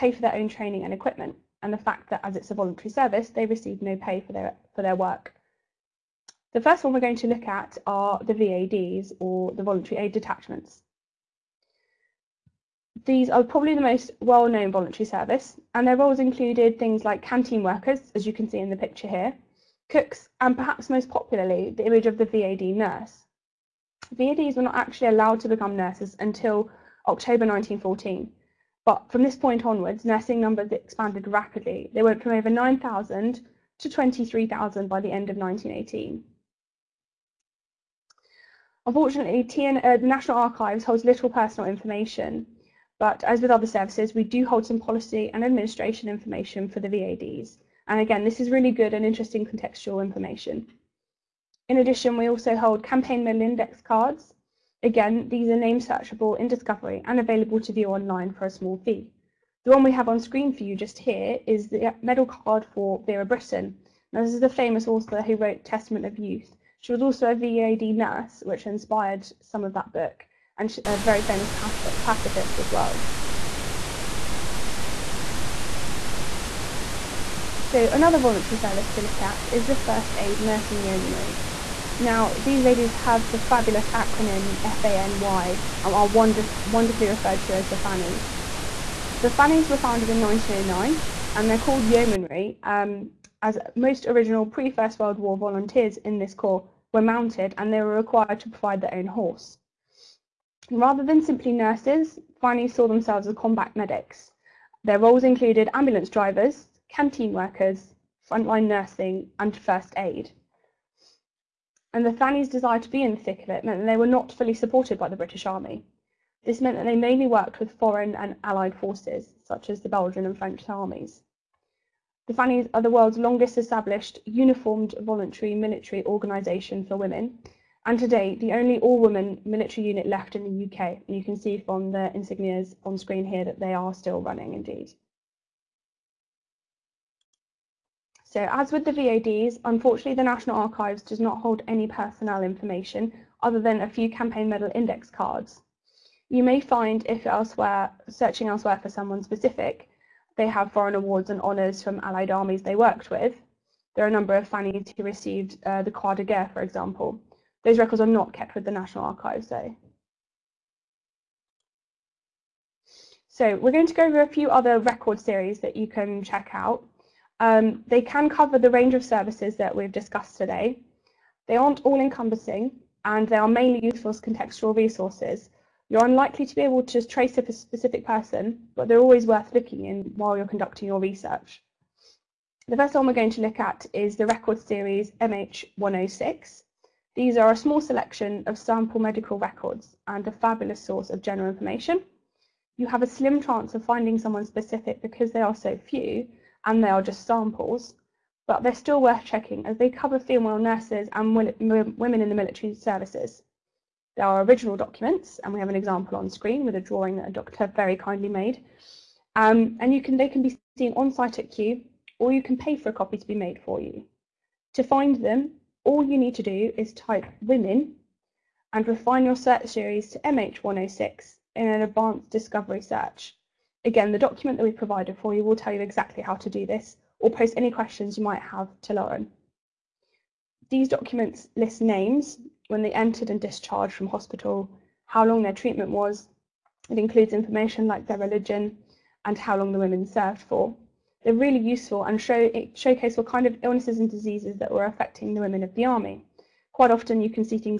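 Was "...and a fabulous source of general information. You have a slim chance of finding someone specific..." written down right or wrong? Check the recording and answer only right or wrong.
right.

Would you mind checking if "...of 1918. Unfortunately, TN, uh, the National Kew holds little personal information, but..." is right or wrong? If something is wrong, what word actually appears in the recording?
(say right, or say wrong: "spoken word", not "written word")
wrong: "Archives", not "Kew".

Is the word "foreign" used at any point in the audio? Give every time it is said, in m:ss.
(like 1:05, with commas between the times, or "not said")
1:57, 2:30.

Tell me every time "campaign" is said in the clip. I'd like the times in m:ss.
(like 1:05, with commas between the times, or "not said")
0:52, 2:24.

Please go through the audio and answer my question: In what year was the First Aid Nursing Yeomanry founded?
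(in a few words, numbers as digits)
1909.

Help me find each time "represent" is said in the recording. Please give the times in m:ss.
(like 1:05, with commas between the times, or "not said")
not said.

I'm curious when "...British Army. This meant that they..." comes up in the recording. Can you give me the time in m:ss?
1:55.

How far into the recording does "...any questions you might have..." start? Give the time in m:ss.
3:47.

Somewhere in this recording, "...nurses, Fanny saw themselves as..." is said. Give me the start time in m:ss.
1:41.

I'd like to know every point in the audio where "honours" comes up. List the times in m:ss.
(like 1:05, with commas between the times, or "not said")
2:31.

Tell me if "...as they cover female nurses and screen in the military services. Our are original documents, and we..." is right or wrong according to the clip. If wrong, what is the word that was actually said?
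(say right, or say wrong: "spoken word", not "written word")
wrong: "women", not "screen".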